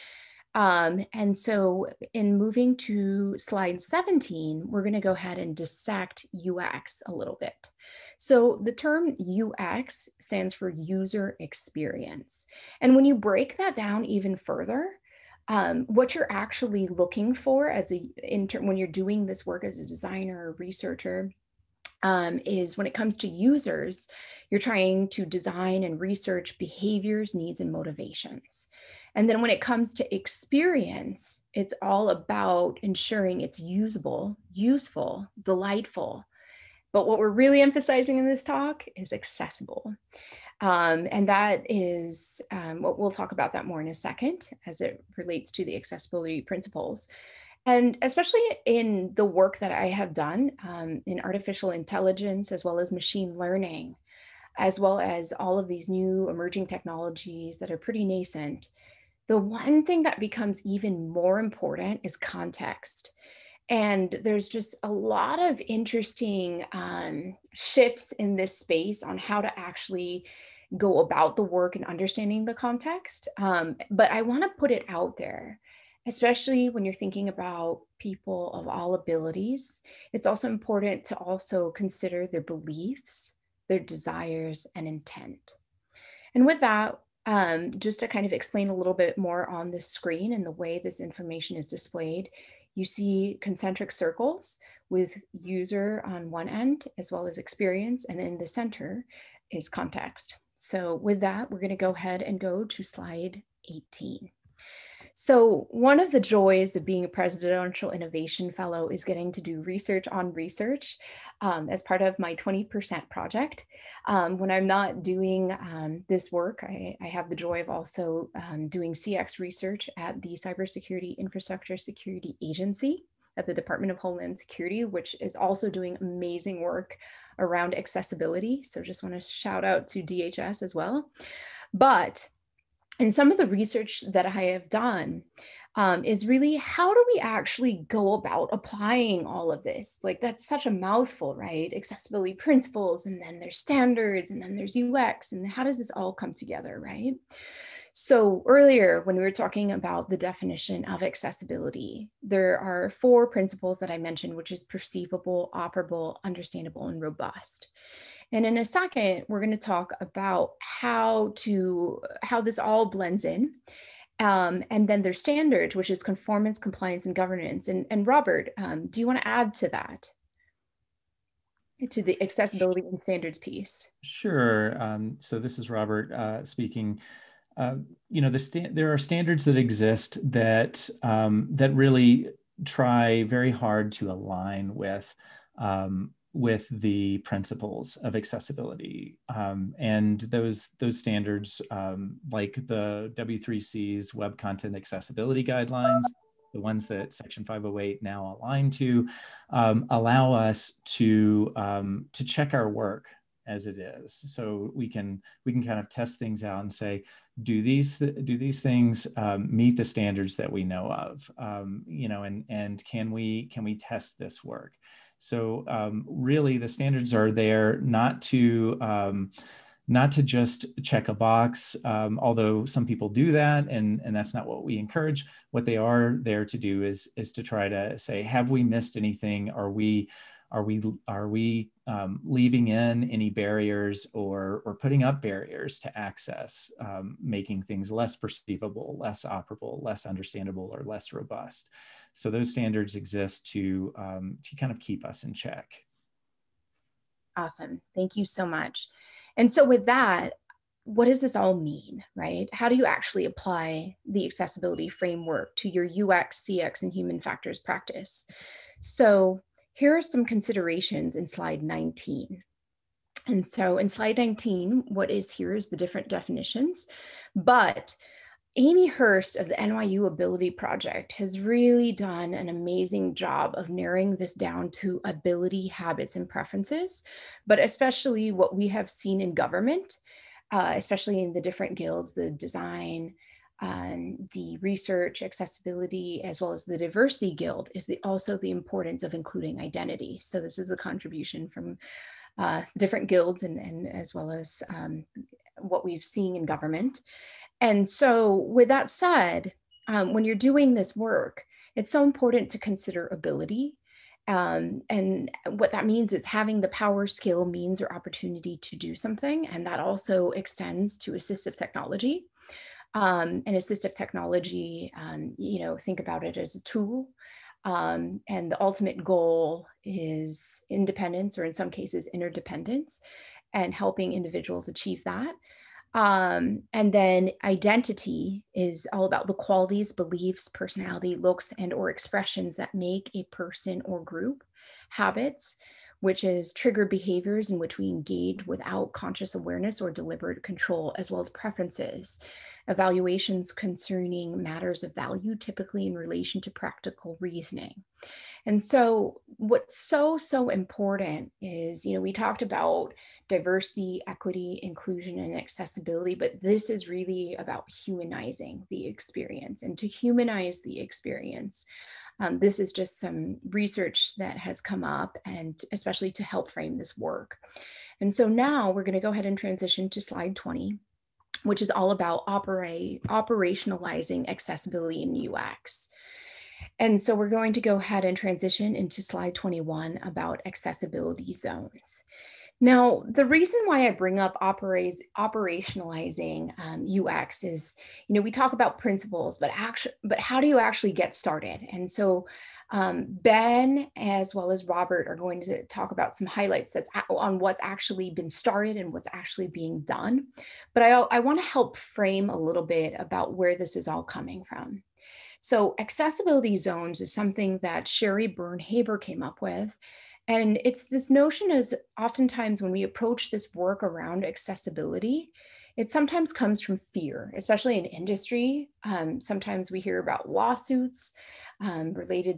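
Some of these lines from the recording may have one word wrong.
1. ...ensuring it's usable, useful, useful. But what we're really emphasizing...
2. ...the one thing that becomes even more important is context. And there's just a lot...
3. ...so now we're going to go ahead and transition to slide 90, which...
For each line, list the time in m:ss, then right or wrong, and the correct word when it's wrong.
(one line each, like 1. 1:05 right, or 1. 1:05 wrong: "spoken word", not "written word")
1. 0:32 wrong: "delightful", not "useful"
2. 0:59 right
3. 6:08 wrong: "20", not "90".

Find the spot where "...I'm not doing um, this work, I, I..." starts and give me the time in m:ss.
1:54.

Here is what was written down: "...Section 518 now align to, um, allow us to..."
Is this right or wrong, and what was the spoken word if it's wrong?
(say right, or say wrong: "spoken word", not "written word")
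wrong: "508", not "518".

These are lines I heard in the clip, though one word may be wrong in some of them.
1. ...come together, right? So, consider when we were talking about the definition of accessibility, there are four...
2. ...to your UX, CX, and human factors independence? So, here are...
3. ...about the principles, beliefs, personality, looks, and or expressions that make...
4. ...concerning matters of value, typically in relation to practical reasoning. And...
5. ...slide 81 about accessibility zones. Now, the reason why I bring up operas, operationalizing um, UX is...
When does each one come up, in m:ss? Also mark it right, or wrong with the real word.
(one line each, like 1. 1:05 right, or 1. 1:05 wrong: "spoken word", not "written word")
1. 2:26 wrong: "earlier", not "consider"
2. 4:15 wrong: "practice", not "independence"
3. 5:29 wrong: "qualities", not "principles"
4. 5:43 right
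5. 6:19 wrong: "21", not "81".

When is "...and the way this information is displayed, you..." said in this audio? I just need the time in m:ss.
1:30.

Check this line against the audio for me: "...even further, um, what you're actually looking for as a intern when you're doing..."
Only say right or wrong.
right.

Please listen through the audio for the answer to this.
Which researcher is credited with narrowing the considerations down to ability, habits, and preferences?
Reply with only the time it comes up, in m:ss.
4:28.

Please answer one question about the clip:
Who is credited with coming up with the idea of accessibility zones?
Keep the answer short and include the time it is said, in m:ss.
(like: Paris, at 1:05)
Sherry Byrne-Haber, at 6:47.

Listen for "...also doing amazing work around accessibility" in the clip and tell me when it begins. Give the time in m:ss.
2:05.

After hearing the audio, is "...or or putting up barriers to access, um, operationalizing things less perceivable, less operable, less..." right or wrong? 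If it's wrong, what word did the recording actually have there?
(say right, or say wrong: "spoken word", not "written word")
wrong: "making", not "operationalizing".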